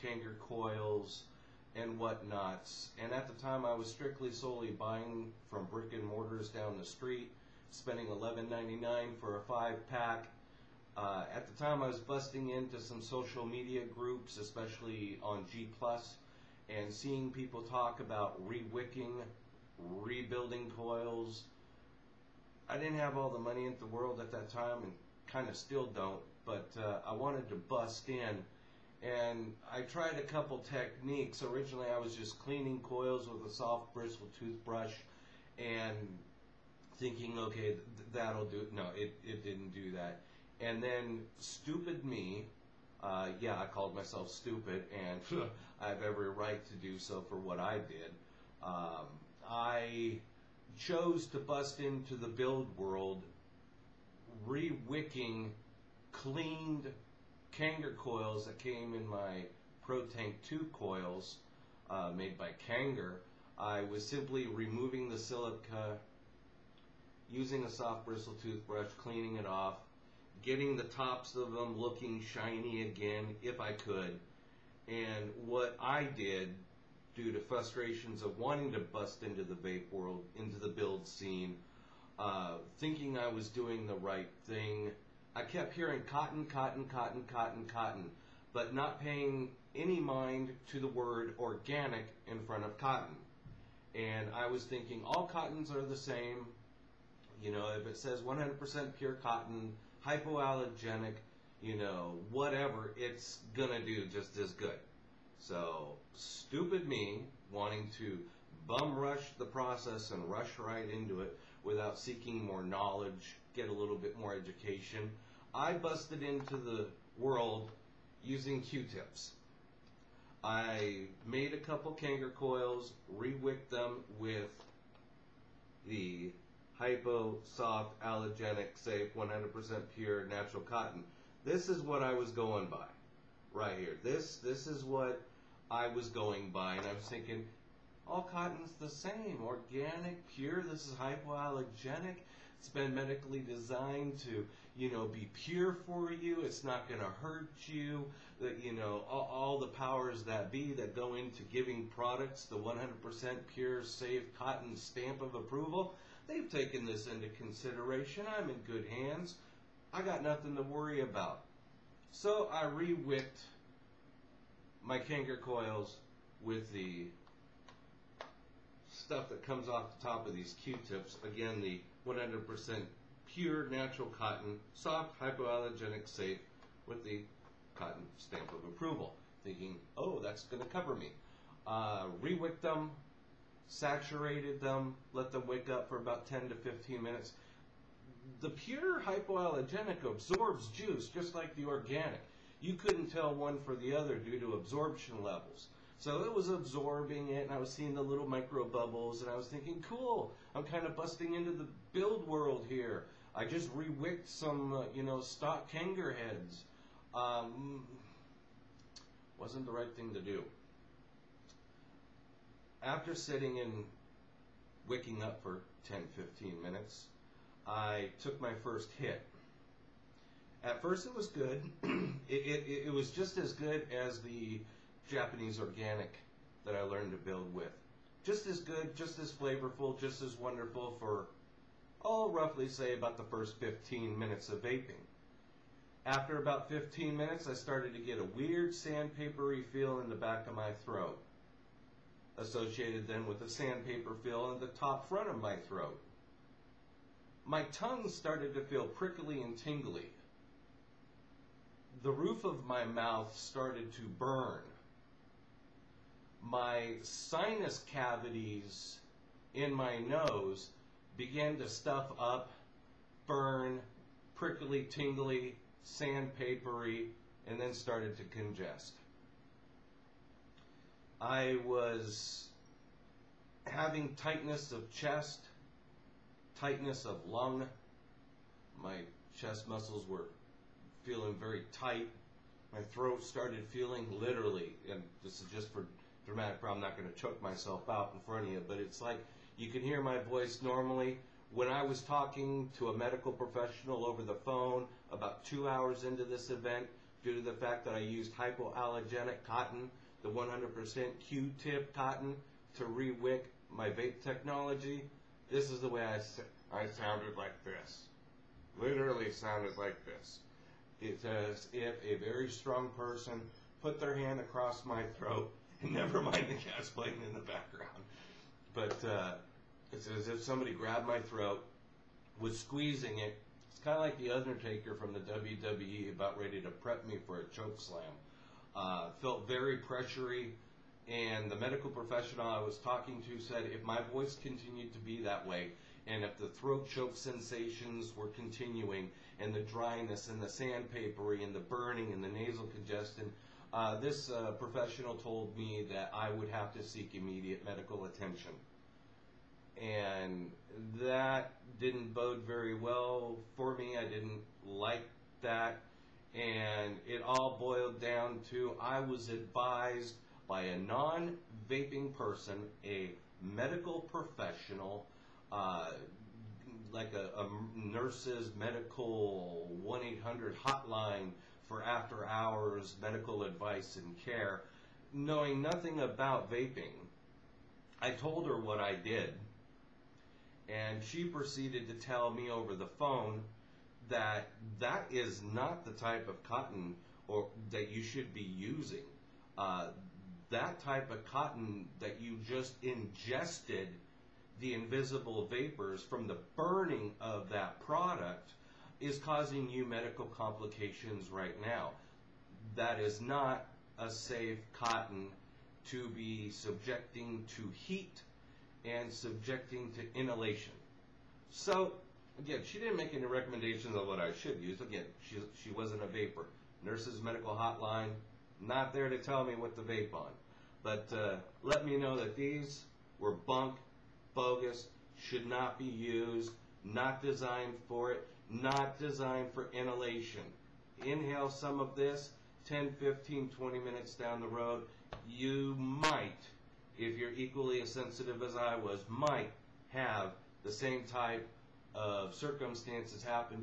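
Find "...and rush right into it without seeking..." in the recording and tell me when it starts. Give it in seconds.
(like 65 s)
110 s.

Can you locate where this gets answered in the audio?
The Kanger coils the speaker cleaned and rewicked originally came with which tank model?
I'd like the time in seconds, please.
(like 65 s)
59 s.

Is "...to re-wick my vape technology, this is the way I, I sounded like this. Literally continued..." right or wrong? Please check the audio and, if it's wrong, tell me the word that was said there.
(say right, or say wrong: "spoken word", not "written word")
wrong: "sounded", not "continued".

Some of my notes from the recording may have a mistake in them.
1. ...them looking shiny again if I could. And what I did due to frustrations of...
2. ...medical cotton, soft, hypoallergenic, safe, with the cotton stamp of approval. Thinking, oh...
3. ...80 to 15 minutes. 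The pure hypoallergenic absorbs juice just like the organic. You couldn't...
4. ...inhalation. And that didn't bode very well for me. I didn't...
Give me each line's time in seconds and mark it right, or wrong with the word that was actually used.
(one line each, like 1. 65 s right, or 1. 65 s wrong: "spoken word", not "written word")
1. 71 s right
2. 173 s wrong: "natural", not "medical"
3. 186 s wrong: "10", not "80"
4. 348 s wrong: "attention", not "inhalation".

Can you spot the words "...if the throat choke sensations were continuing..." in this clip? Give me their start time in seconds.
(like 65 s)
336 s.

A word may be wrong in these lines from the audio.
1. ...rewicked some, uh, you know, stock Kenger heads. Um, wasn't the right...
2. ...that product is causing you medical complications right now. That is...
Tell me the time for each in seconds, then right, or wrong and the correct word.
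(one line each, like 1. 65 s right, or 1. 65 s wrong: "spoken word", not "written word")
1. 203 s right
2. 397 s right.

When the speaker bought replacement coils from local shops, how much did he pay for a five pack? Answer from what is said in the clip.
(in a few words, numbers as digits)
$11.99.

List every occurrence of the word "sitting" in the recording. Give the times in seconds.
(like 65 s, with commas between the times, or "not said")
213 s.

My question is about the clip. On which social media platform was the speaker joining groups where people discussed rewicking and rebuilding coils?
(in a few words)
G+.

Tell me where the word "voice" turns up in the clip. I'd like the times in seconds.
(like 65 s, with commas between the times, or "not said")
290 s, 334 s.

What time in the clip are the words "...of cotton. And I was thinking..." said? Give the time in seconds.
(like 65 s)
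92 s.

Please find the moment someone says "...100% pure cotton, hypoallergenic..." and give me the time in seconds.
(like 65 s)
98 s.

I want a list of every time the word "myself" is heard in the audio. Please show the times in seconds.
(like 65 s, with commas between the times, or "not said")
43 s, 287 s.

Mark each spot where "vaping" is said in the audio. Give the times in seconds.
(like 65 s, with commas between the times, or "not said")
234 s, 361 s, 376 s.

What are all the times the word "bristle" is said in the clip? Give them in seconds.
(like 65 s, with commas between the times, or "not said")
33 s, 68 s.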